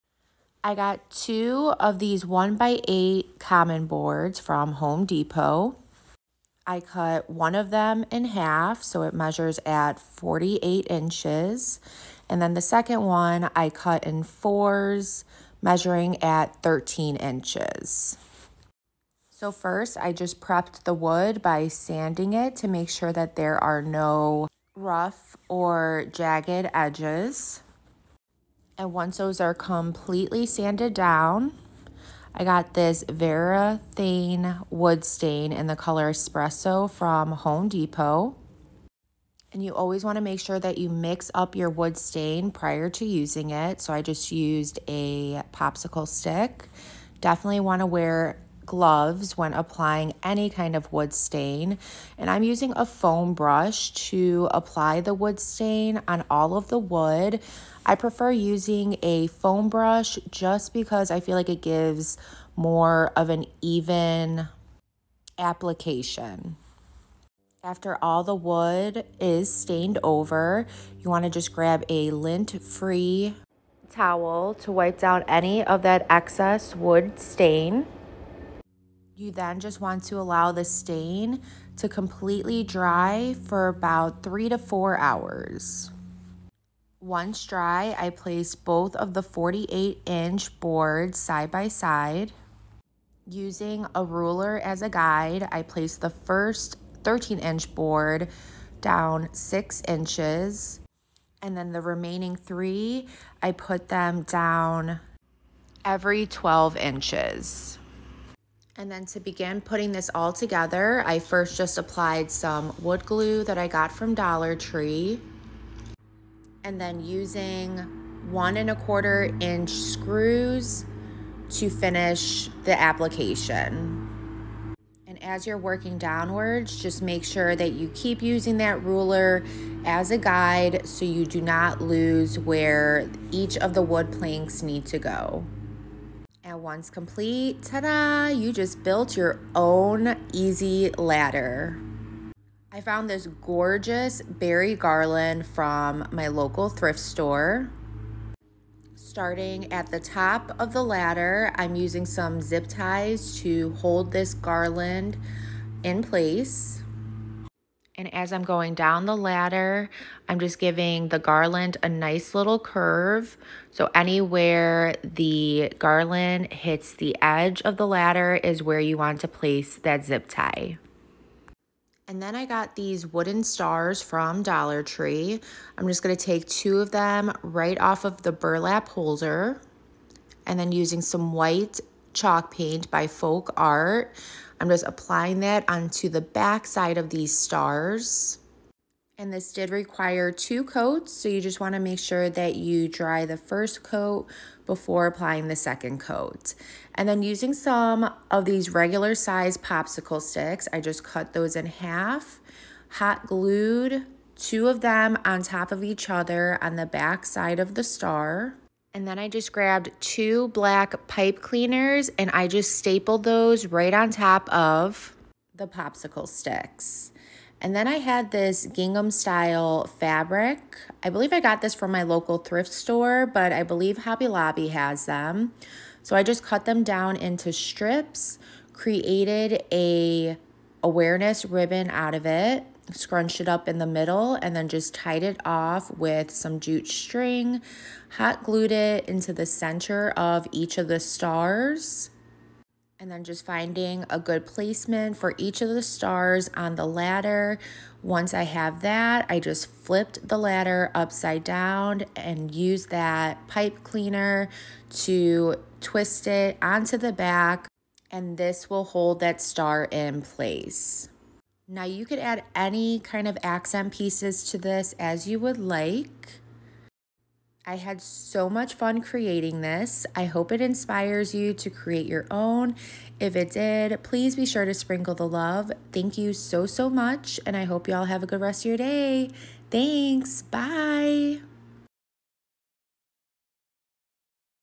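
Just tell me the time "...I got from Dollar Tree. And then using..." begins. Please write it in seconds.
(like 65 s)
113 s.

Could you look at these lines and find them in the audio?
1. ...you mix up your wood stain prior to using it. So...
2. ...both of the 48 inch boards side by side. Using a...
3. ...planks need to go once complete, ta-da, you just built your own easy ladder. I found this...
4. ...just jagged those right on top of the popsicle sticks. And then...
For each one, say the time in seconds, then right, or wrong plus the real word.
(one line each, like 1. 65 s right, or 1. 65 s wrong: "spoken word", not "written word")
1. 40 s right
2. 88 s right
3. 134 s right
4. 212 s wrong: "stapled", not "jagged".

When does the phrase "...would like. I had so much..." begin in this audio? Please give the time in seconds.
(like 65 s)
265 s.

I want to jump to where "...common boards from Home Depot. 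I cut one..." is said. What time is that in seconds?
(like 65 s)
3 s.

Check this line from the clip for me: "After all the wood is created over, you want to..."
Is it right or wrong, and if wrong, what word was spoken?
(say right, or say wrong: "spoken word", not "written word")
wrong: "stained", not "created".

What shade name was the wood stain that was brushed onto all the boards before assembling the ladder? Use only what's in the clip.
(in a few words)
Espresso.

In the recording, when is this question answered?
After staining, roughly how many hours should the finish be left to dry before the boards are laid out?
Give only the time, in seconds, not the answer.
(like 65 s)
84 s.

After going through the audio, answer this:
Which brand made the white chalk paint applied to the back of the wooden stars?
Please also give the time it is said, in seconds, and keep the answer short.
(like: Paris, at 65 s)
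Folk Art, at 183 s.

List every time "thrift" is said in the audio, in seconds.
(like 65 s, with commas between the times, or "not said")
146 s, 222 s.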